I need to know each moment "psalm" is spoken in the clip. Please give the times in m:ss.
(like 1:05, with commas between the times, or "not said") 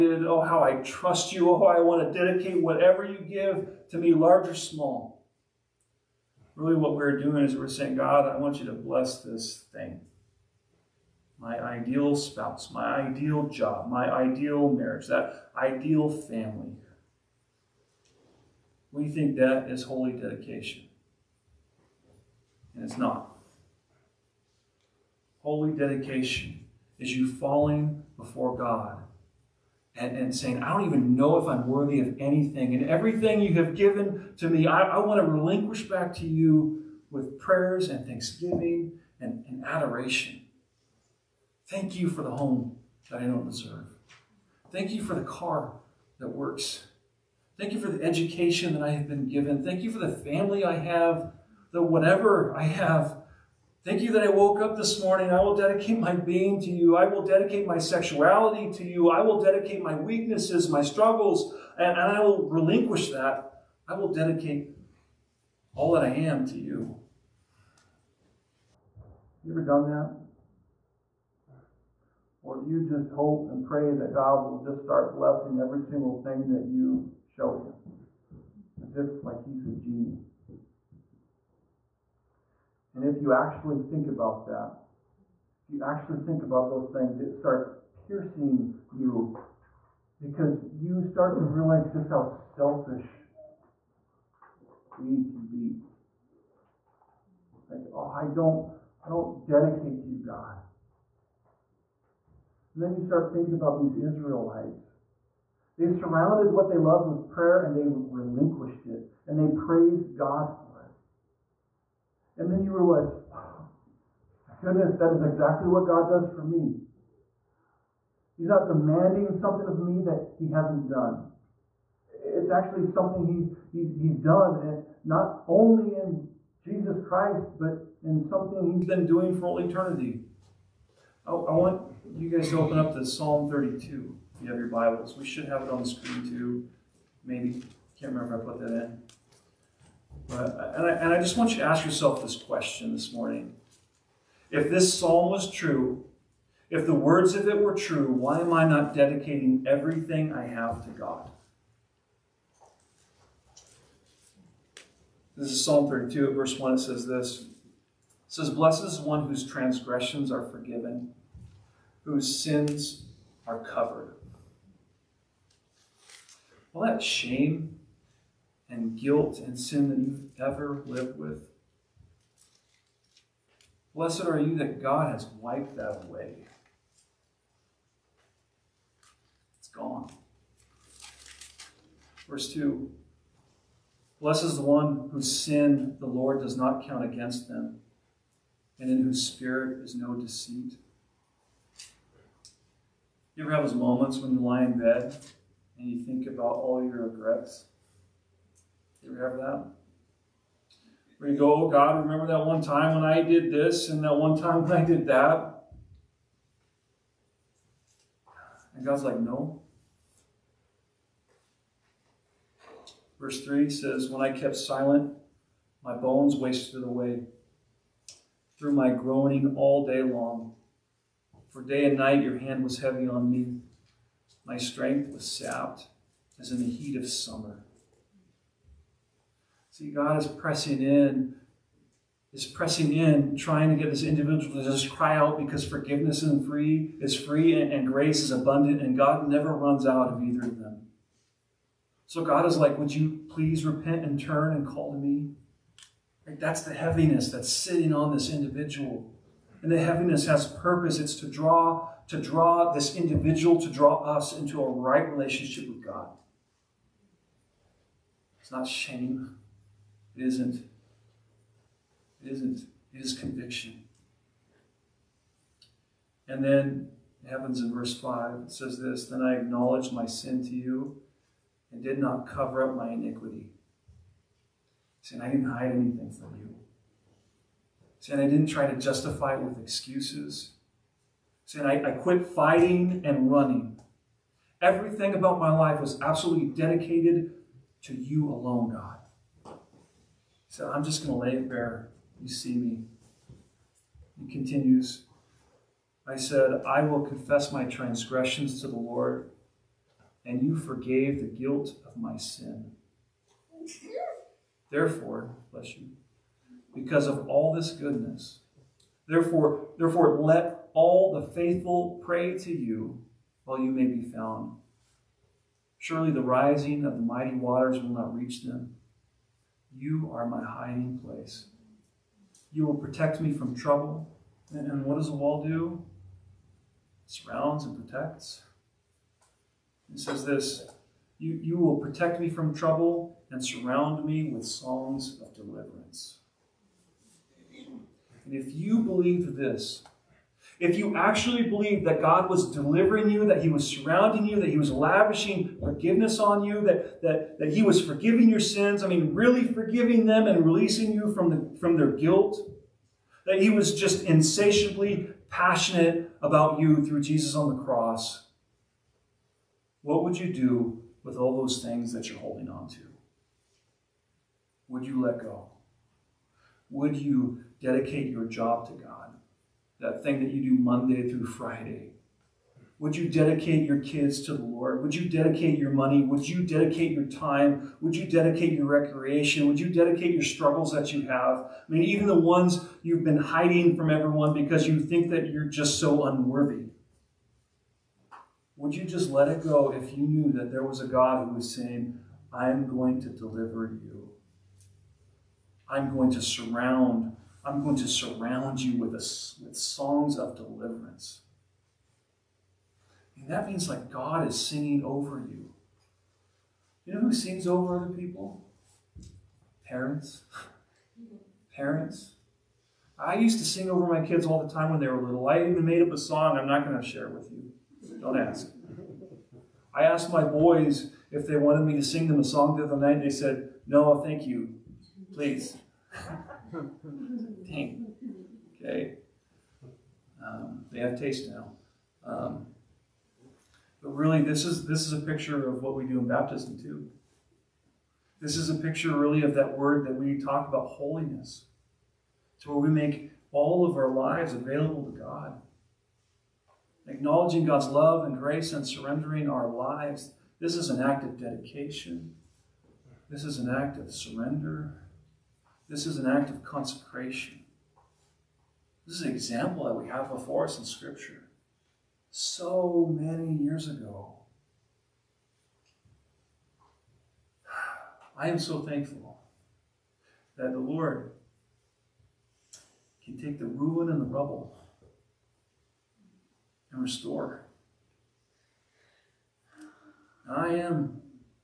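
2:13, 2:24, 2:35.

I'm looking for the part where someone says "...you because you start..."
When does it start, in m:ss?
1:28.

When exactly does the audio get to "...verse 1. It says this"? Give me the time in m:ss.
2:36.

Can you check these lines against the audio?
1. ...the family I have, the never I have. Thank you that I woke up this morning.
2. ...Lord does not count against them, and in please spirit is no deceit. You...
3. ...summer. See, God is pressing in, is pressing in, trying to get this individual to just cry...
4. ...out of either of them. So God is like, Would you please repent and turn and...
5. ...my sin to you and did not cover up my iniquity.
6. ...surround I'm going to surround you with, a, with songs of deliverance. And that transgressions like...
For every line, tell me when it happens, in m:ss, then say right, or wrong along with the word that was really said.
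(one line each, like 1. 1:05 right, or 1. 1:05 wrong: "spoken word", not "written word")
1. 0:49 wrong: "whatever", not "never"
2. 3:06 wrong: "whose", not "please"
3. 3:47 right
4. 3:59 right
5. 4:29 right
6. 6:36 wrong: "means", not "transgressions".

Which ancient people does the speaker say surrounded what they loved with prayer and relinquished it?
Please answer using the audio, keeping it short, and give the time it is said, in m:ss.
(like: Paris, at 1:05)
Israelites, at 1:43.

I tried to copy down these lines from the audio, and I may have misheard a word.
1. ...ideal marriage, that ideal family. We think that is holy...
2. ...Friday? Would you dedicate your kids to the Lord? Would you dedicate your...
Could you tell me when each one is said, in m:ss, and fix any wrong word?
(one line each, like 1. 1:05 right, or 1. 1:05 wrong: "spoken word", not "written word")
1. 0:14 right
2. 6:11 right.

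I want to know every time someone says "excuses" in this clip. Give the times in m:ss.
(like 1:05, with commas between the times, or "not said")
4:39.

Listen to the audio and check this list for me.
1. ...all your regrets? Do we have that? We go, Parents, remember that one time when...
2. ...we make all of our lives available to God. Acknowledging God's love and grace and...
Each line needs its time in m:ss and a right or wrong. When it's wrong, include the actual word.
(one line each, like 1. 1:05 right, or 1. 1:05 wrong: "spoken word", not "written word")
1. 3:16 wrong: "God", not "Parents"
2. 7:22 right.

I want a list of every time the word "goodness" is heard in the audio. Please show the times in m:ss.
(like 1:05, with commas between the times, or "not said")
1:54, 5:07.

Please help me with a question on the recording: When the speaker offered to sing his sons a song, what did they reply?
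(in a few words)
No, thank you.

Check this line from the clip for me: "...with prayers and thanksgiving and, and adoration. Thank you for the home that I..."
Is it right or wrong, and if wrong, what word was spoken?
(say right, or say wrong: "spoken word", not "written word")
right.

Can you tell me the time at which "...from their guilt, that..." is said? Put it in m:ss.
5:51.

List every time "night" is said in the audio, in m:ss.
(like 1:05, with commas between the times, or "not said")
3:41, 7:02.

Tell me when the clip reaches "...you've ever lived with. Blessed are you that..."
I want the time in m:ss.
2:49.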